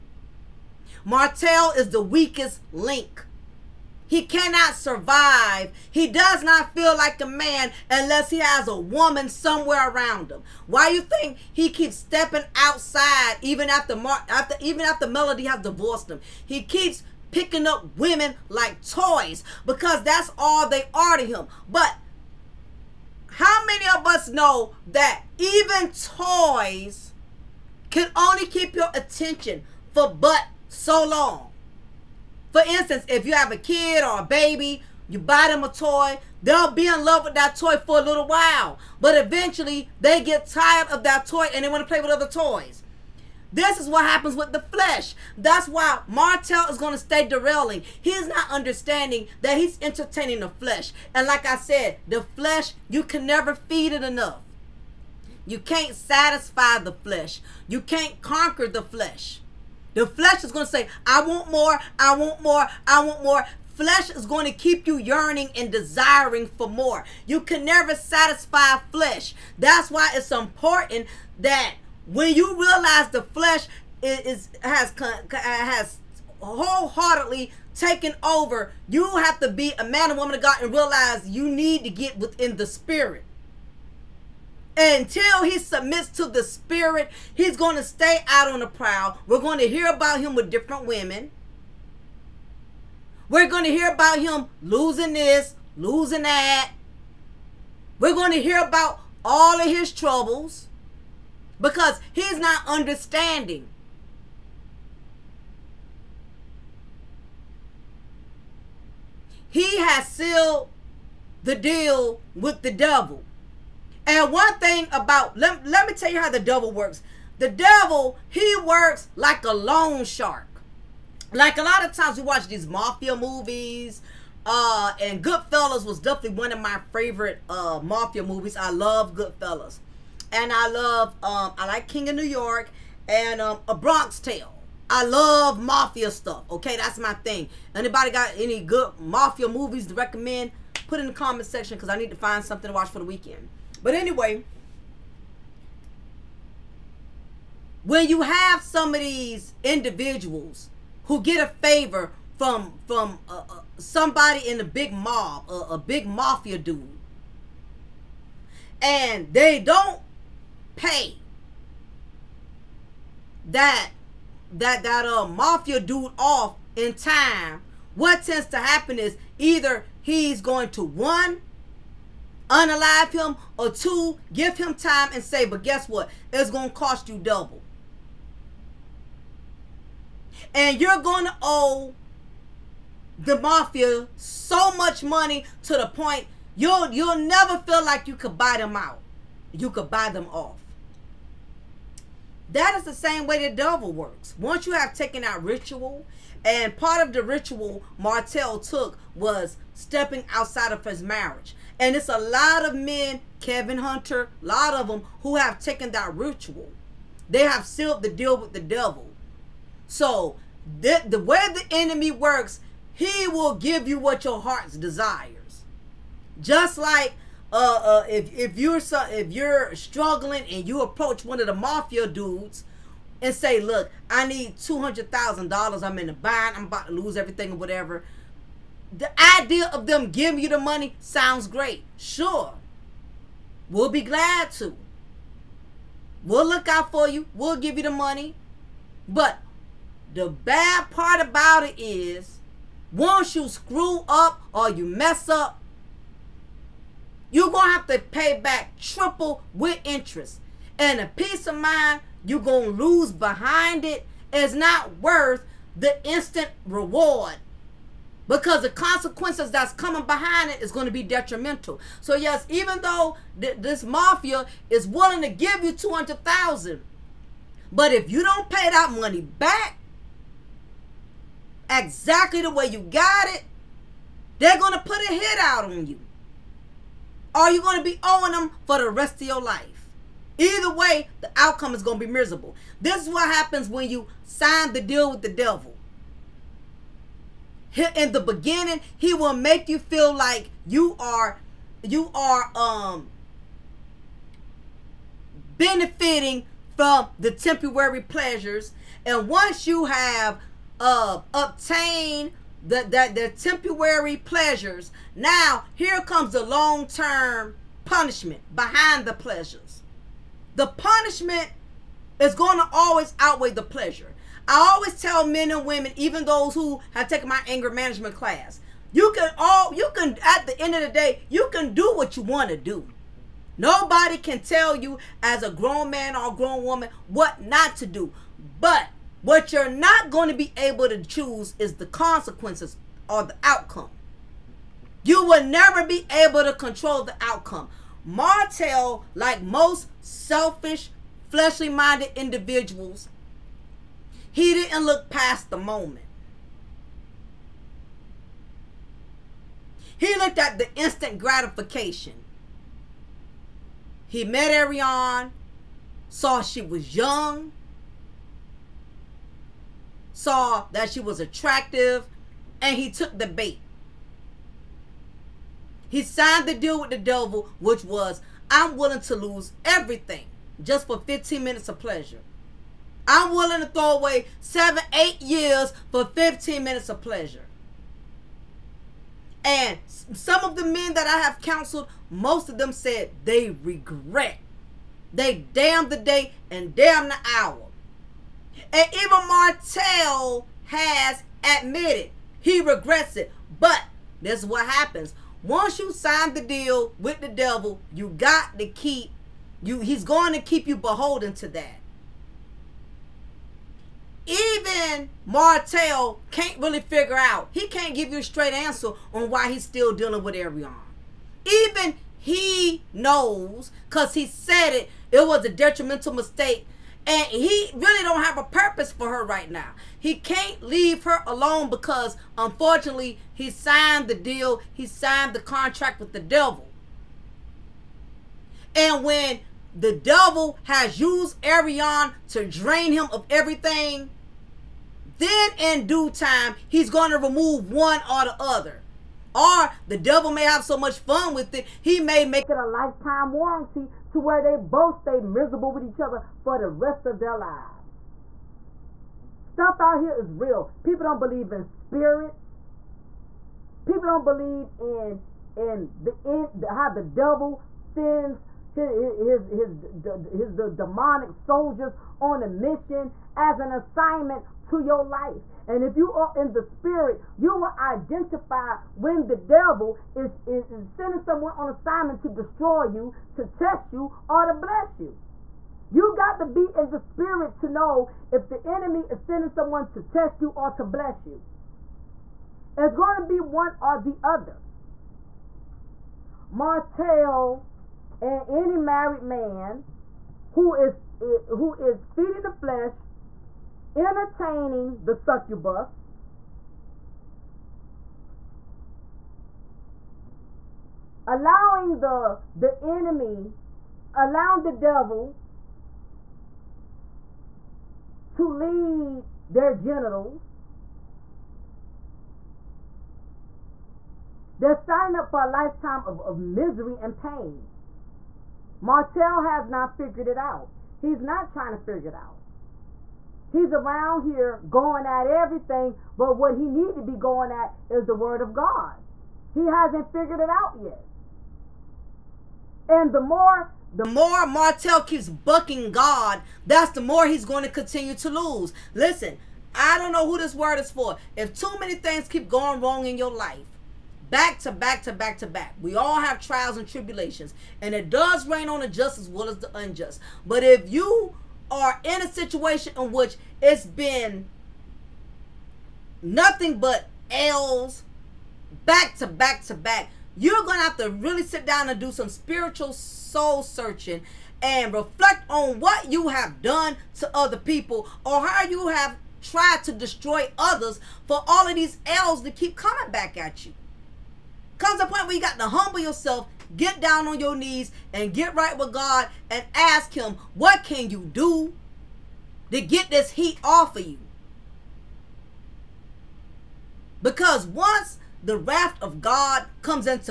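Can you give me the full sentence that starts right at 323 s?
Nobody can tell you as a grown man or grown woman what not to do.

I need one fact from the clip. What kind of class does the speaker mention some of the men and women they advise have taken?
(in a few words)
Anger management.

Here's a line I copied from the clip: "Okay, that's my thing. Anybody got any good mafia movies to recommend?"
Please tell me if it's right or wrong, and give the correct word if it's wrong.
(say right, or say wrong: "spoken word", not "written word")
right.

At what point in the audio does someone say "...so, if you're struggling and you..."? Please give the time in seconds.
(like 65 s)
218 s.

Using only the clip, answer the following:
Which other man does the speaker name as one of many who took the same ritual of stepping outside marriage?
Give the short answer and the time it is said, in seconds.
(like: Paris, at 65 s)
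Kevin Hunter, at 203 s.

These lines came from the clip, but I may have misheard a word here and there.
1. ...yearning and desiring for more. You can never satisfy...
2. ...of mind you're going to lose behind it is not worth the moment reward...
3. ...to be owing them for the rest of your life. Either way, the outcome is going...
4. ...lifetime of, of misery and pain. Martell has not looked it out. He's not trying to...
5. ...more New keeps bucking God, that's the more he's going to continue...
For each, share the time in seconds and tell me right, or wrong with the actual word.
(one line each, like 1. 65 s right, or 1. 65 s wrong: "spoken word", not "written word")
1. 64 s right
2. 251 s wrong: "instant", not "moment"
3. 277 s right
4. 515 s wrong: "figured", not "looked"
5. 534 s wrong: "Martell", not "New".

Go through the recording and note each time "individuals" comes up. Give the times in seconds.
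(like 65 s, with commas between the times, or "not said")
149 s, 342 s.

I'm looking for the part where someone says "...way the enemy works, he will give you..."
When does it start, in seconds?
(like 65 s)
211 s.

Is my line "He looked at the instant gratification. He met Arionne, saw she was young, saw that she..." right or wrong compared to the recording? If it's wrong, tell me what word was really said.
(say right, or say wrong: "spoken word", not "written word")
right.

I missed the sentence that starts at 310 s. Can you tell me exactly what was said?
The punishment is going to always outweigh the pleasure.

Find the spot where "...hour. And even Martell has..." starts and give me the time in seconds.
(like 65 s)
387 s.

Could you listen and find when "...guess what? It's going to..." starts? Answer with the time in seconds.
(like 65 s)
175 s.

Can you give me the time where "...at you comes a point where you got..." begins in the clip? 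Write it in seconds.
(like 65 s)
573 s.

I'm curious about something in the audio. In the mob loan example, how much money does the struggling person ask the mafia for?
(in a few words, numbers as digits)
$200,000.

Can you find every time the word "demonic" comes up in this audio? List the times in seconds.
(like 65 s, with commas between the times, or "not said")
460 s.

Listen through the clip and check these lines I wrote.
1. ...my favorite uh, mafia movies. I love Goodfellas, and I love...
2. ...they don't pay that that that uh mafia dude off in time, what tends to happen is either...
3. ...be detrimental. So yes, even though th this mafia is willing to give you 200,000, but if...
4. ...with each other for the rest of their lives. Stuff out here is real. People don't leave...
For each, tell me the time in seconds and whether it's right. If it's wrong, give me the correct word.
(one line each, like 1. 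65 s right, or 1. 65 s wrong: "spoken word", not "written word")
1. 126 s right
2. 159 s right
3. 260 s right
4. 445 s wrong: "believe", not "leave".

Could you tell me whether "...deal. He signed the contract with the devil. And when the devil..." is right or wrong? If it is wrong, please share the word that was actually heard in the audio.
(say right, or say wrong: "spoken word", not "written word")
right.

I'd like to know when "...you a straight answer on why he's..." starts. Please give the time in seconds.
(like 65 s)
408 s.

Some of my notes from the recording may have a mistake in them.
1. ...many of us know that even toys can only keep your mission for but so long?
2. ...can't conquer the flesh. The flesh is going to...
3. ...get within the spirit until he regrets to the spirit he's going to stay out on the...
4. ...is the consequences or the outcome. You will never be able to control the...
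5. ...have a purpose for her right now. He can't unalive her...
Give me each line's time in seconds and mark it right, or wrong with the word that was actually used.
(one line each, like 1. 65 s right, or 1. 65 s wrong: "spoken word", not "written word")
1. 23 s wrong: "attention", not "mission"
2. 57 s right
3. 81 s wrong: "submits", not "regrets"
4. 331 s right
5. 418 s wrong: "leave", not "unalive".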